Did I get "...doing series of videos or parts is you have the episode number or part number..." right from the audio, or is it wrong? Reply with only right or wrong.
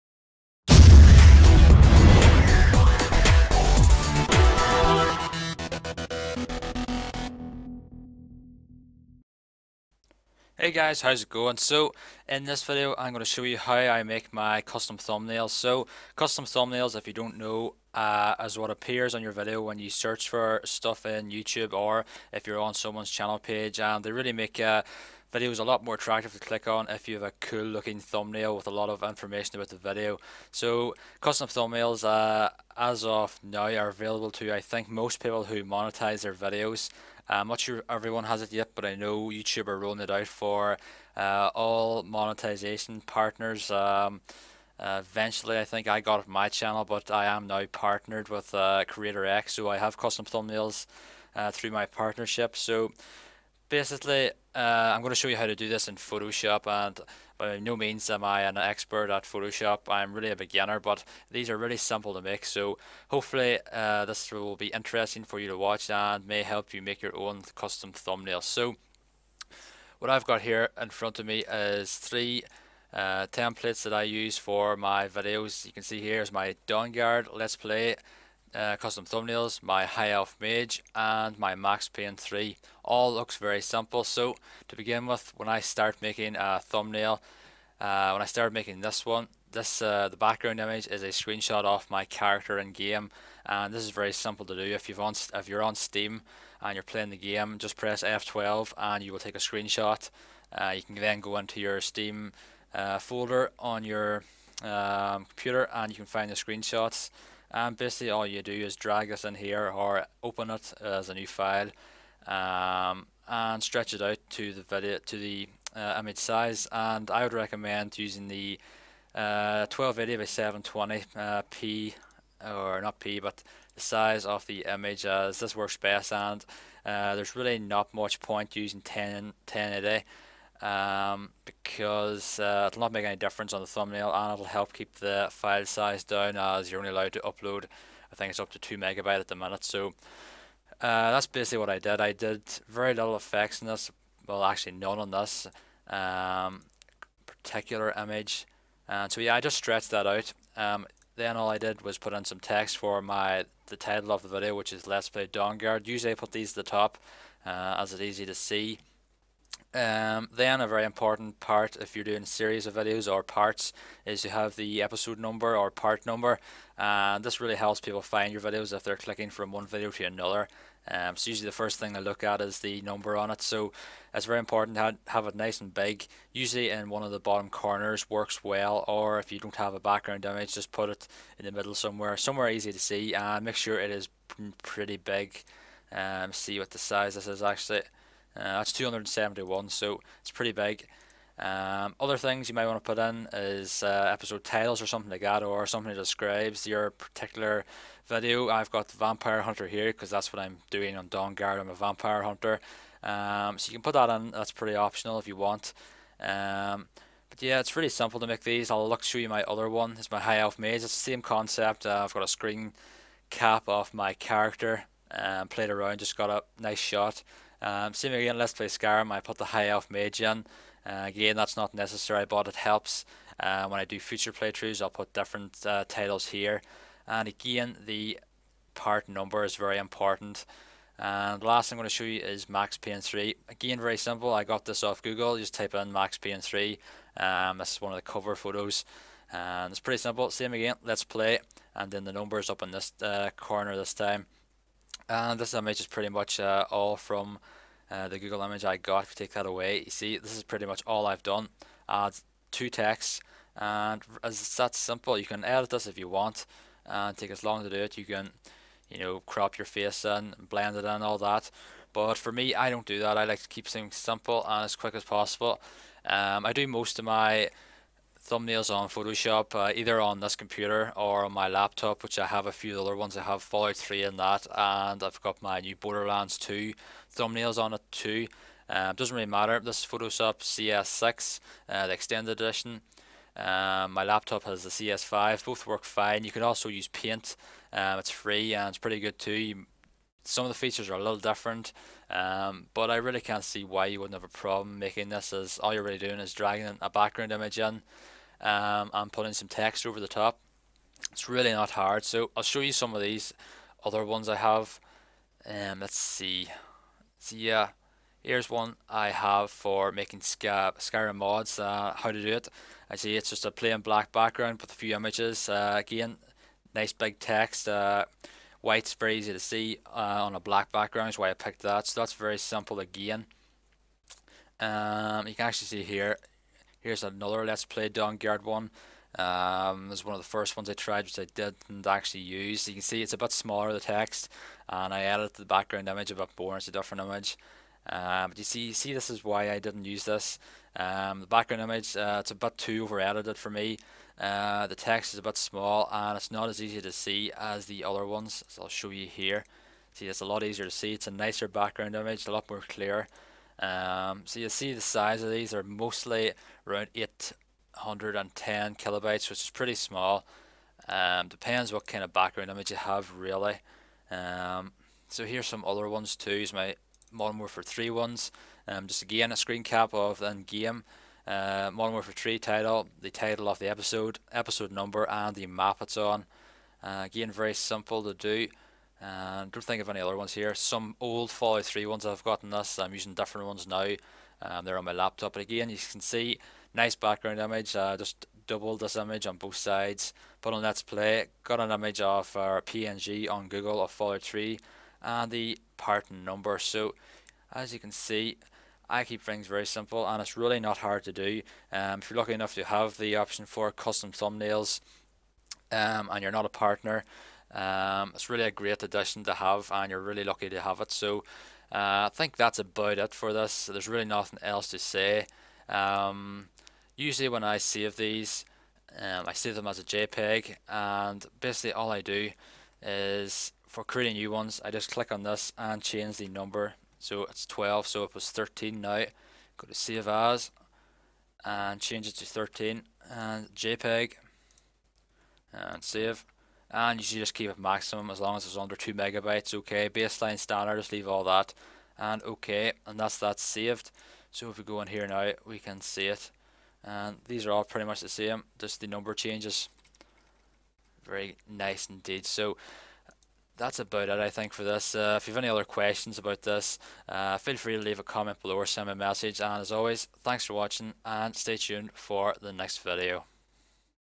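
right.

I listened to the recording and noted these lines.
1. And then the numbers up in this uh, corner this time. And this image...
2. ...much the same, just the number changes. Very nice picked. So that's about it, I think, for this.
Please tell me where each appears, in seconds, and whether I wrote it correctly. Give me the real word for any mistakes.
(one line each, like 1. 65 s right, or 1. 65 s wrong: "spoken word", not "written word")
1. 241 s right
2. 447 s wrong: "indeed", not "picked".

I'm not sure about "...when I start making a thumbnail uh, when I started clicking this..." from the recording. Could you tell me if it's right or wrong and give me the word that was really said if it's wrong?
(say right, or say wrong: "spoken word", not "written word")
wrong: "making", not "clicking".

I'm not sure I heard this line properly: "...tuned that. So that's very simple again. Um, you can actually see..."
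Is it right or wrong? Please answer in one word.
wrong.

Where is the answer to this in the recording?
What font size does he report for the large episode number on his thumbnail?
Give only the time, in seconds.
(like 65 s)
188 s.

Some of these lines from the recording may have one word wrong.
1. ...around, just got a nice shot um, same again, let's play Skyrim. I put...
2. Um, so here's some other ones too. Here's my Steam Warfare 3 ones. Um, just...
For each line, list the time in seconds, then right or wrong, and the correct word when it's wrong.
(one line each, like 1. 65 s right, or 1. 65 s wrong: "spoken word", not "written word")
1. 215 s right
2. 364 s wrong: "Modern", not "Steam".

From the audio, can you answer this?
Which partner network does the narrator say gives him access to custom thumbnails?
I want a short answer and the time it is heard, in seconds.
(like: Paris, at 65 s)
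Creator X, at 48 s.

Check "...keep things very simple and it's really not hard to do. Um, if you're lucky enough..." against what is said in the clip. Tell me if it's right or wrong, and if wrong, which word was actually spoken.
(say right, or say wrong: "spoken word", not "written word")
right.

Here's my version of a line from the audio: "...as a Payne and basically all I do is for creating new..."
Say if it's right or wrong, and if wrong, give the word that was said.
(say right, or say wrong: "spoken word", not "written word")
wrong: "JPEG", not "Payne".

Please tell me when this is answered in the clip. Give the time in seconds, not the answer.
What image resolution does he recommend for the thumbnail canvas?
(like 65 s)
119 s.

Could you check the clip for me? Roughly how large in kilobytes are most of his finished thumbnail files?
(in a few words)
810 kilobytes.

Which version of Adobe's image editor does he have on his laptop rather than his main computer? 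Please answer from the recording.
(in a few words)
CS5.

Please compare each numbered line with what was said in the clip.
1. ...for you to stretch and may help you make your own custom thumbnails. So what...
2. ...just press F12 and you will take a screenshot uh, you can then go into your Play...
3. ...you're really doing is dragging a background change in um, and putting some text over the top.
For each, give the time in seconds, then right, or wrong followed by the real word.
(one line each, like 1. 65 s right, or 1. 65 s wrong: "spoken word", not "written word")
1. 65 s wrong: "watch", not "stretch"
2. 97 s wrong: "Steam", not "Play"
3. 295 s wrong: "image", not "change".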